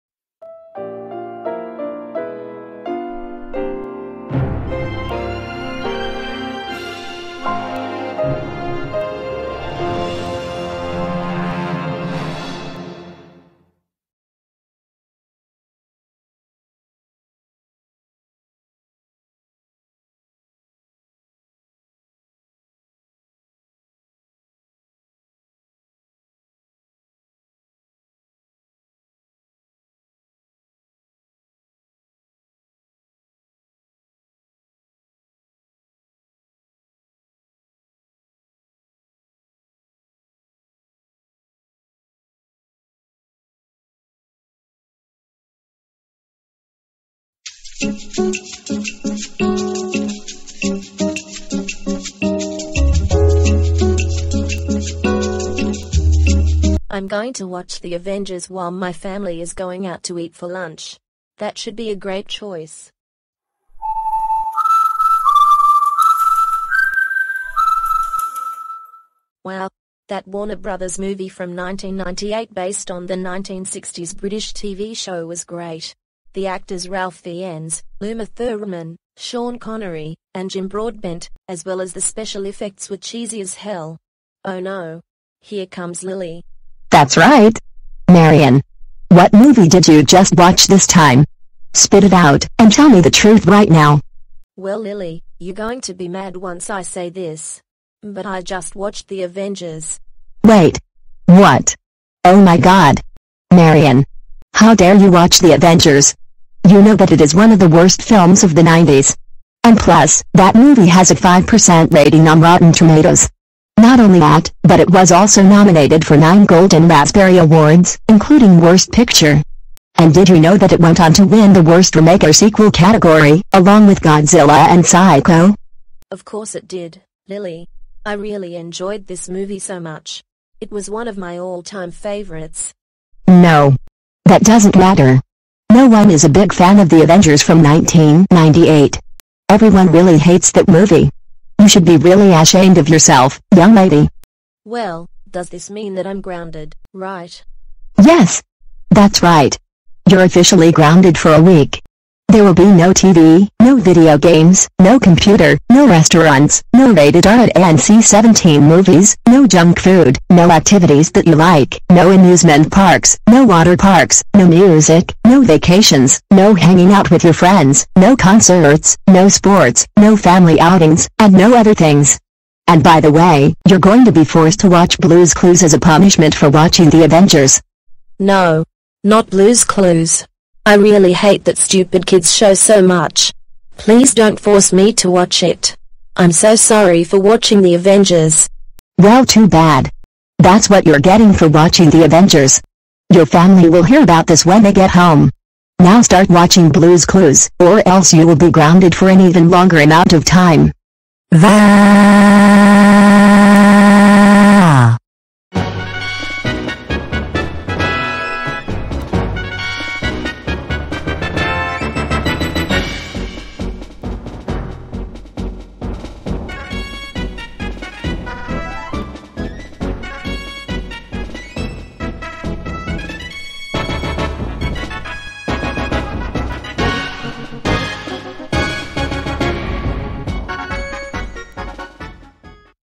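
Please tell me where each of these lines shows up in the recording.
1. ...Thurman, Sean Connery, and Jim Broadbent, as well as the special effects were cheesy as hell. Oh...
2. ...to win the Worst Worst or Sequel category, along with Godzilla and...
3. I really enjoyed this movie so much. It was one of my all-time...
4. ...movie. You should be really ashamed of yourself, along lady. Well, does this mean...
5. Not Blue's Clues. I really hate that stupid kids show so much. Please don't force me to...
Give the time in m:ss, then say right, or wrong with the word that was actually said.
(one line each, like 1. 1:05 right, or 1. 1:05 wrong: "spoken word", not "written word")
1. 1:18 right
2. 2:01 wrong: "Remake", not "Worst"
3. 2:08 right
4. 2:20 wrong: "young", not "along"
5. 2:59 right.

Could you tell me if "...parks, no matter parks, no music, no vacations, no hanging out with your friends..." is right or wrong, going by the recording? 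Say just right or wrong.
wrong.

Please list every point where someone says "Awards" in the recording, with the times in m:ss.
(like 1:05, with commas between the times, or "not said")
1:57.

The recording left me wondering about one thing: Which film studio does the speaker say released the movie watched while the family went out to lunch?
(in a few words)
Warner Brothers.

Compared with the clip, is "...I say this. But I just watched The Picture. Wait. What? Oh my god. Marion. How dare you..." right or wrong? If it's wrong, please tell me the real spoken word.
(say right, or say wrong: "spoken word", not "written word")
wrong: "Avengers", not "Picture".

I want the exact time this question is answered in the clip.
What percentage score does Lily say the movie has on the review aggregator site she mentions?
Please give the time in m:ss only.
1:51.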